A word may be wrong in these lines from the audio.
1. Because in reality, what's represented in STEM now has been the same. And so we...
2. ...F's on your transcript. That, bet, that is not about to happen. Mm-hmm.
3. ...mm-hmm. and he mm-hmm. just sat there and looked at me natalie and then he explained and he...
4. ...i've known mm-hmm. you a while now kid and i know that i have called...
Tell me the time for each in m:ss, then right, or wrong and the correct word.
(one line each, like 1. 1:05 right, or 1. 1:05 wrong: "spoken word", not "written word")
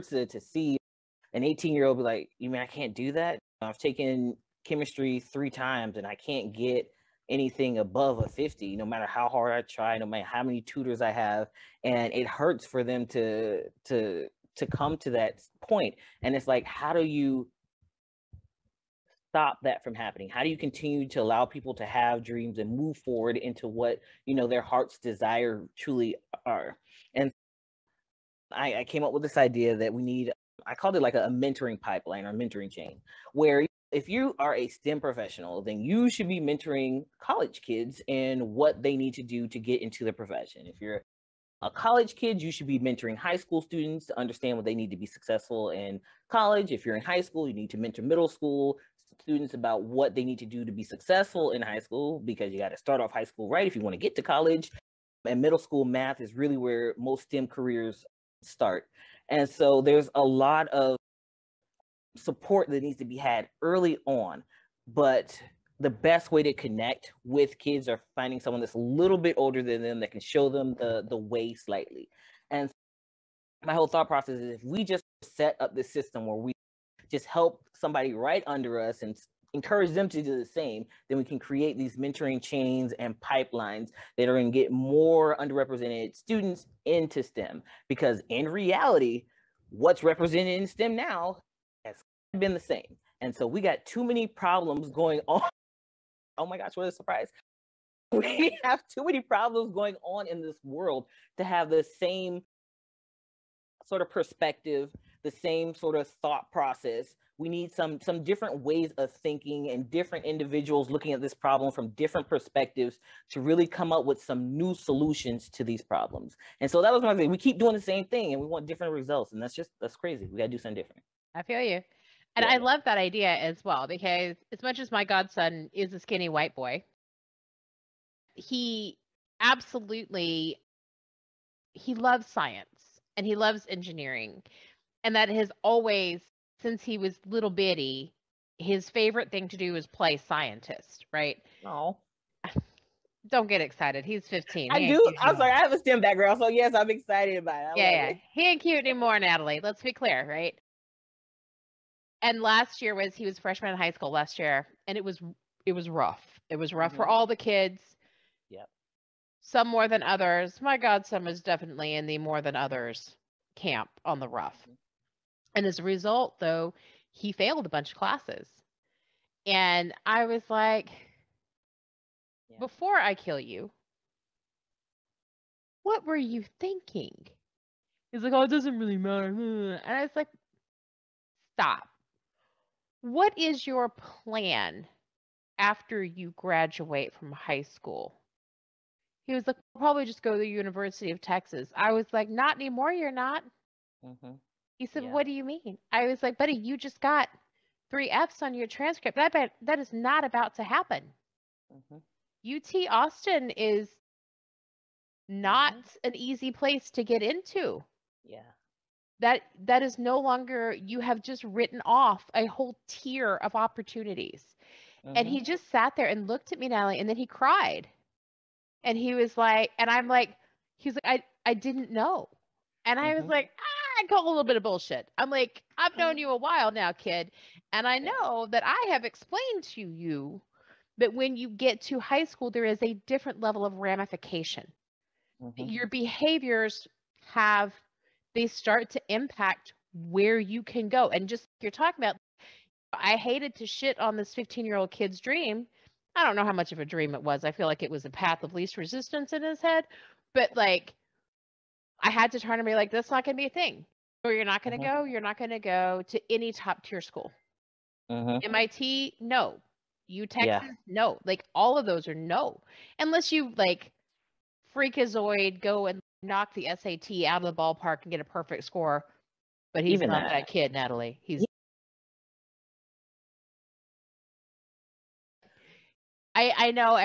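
1. 1:27 right
2. 3:18 right
3. 3:35 wrong: "cried", not "explained"
4. 3:45 wrong: "explained", not "called".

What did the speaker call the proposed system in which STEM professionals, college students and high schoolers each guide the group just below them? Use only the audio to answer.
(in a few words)
mentoring pipeline.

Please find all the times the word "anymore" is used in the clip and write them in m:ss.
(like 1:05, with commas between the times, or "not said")
2:28, 3:12.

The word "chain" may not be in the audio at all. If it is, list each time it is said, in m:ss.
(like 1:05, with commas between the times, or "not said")
0:32, 1:22.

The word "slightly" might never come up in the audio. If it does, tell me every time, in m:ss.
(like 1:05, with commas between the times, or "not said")
1:11.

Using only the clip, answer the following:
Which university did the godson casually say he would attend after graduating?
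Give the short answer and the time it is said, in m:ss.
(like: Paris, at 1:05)
University of Texas, at 3:10.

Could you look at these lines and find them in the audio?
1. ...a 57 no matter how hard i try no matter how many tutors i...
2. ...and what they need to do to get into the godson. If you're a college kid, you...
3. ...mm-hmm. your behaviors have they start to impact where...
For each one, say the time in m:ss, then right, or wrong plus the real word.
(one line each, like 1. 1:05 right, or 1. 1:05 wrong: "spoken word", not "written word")
1. 0:08 wrong: "50", not "57"
2. 0:38 wrong: "profession", not "godson"
3. 3:55 right.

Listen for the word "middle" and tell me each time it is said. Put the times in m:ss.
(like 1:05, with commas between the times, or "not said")
0:48, 0:55.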